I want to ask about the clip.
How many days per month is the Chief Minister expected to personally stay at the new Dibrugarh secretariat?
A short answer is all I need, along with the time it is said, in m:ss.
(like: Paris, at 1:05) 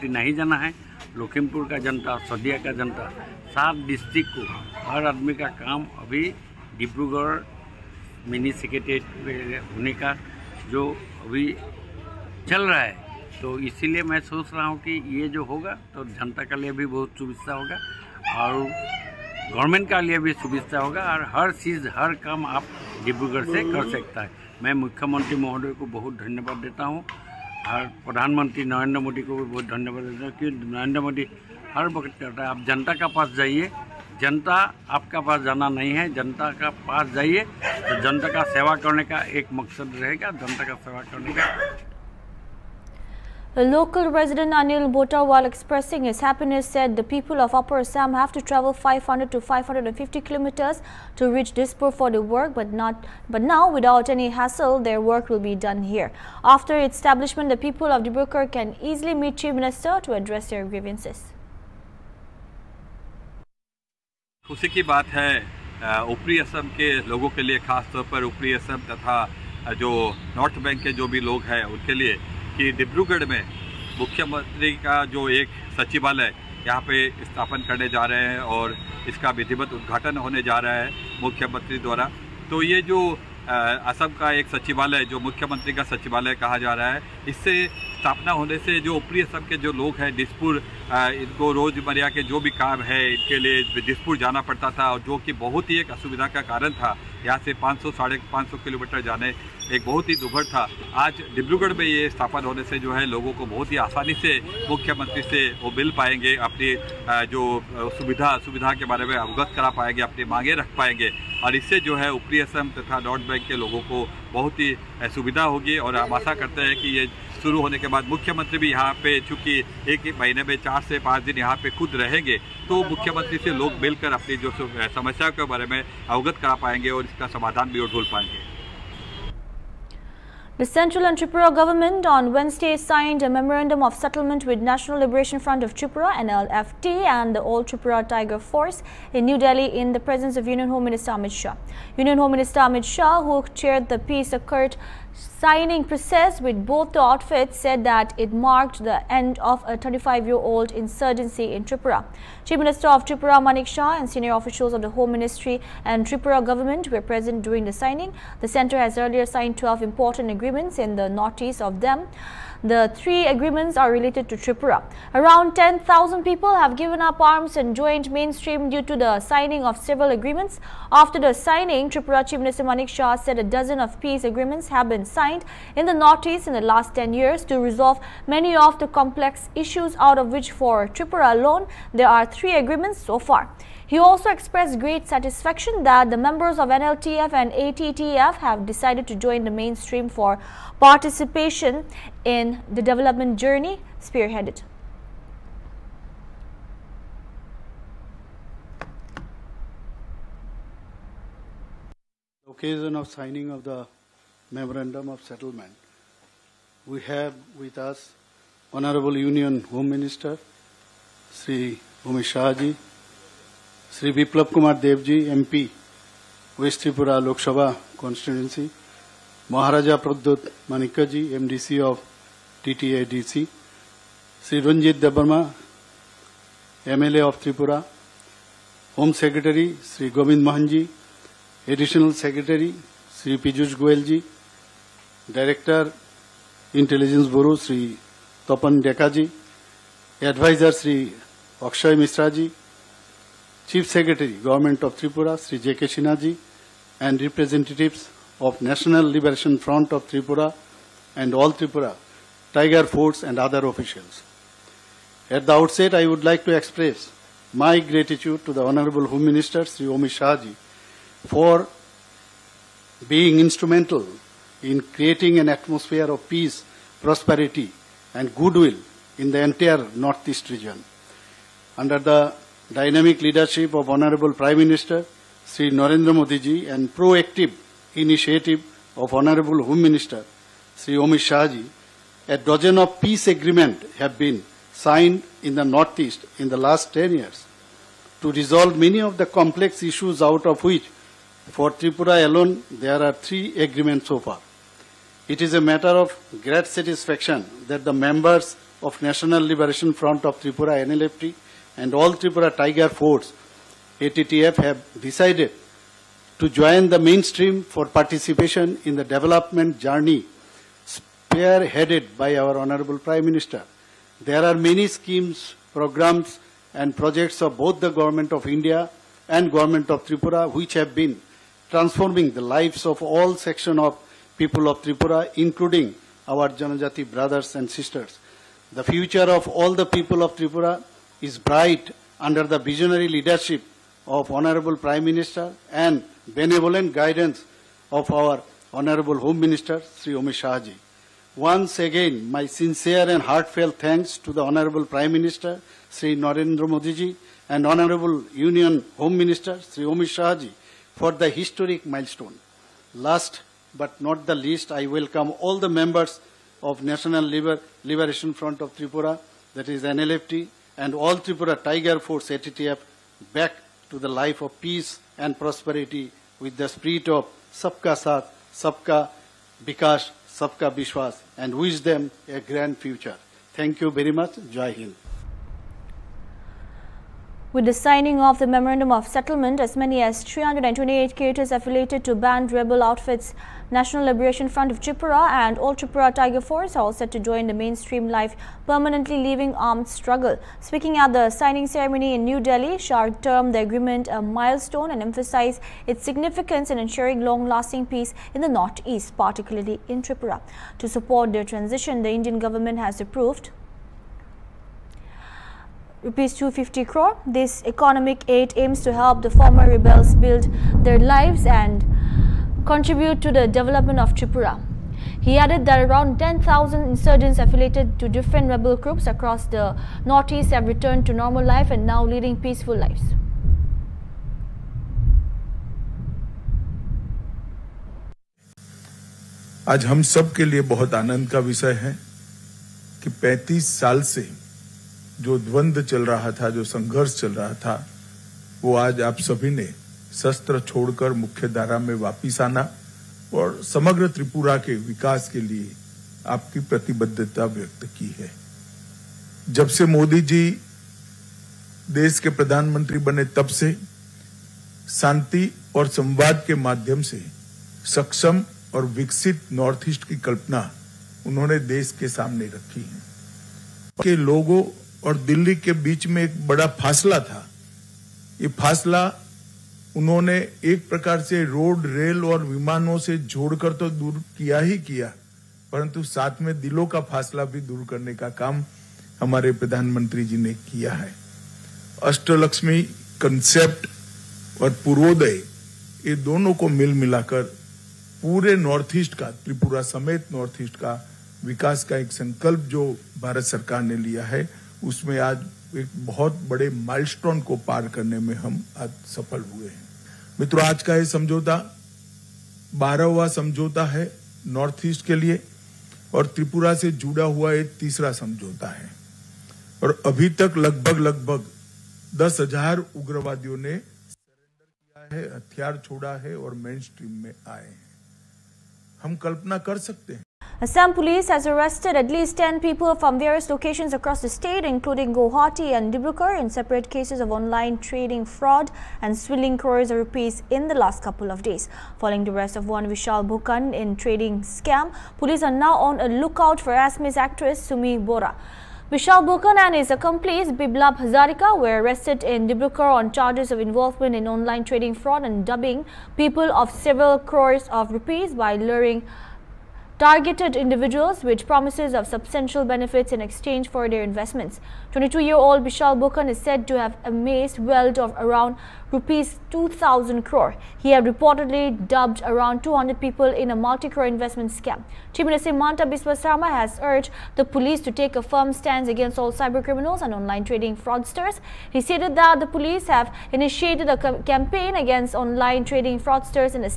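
4 to 5, at 2:00.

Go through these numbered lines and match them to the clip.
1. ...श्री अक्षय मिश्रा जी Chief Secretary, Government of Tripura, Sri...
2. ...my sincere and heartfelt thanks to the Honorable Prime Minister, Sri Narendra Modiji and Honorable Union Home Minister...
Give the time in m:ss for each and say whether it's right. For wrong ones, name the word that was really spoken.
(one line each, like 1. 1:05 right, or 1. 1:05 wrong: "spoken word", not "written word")
1. 4:00 right
2. 5:42 right.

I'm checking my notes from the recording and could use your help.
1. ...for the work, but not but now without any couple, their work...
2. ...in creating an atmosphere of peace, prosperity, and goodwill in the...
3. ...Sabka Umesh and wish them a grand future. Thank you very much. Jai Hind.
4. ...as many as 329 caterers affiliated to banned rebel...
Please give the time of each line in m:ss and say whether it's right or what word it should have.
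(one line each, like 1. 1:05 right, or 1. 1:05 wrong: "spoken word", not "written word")
1. 0:51 wrong: "hassle", not "couple"
2. 4:24 right
3. 6:10 wrong: "Vishwas", not "Umesh"
4. 6:19 wrong: "328", not "329".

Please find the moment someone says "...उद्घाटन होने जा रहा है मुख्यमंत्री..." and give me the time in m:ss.
1:19.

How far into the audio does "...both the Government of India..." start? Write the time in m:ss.
5:17.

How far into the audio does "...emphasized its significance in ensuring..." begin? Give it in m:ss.
6:35.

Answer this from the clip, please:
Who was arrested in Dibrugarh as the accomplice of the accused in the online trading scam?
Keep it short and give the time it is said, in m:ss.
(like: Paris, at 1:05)
Biblab Hazarika, at 9:00.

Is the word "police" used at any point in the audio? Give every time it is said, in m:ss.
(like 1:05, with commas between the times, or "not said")
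8:40, 8:55, 9:27, 9:32.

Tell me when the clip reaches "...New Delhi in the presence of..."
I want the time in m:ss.
2:19.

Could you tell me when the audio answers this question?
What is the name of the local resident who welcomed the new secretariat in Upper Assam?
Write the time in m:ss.
0:44.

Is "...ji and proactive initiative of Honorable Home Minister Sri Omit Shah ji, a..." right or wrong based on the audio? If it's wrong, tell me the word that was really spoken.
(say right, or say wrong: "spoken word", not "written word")
right.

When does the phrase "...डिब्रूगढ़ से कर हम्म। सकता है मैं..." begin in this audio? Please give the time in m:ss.
0:23.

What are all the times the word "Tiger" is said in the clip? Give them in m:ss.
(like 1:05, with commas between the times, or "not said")
2:18, 4:12, 5:02, 6:01, 6:26.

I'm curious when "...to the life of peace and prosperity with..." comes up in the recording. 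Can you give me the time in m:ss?
6:03.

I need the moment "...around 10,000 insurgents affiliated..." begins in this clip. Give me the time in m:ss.
6:55.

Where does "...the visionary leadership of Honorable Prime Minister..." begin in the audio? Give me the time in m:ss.
5:32.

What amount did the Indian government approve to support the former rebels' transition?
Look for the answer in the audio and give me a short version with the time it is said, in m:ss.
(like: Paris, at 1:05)
250 crore rupees, at 6:46.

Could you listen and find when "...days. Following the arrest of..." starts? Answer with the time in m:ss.
8:51.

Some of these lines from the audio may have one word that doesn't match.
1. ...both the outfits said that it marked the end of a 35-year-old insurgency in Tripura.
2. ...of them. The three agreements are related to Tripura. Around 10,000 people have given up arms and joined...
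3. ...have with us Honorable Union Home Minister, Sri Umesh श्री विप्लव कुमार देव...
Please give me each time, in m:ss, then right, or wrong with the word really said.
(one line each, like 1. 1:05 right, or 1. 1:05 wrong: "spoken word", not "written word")
1. 2:26 right
2. 2:41 right
3. 3:26 right.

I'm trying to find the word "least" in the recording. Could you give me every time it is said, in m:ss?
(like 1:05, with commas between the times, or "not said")
5:54, 8:42.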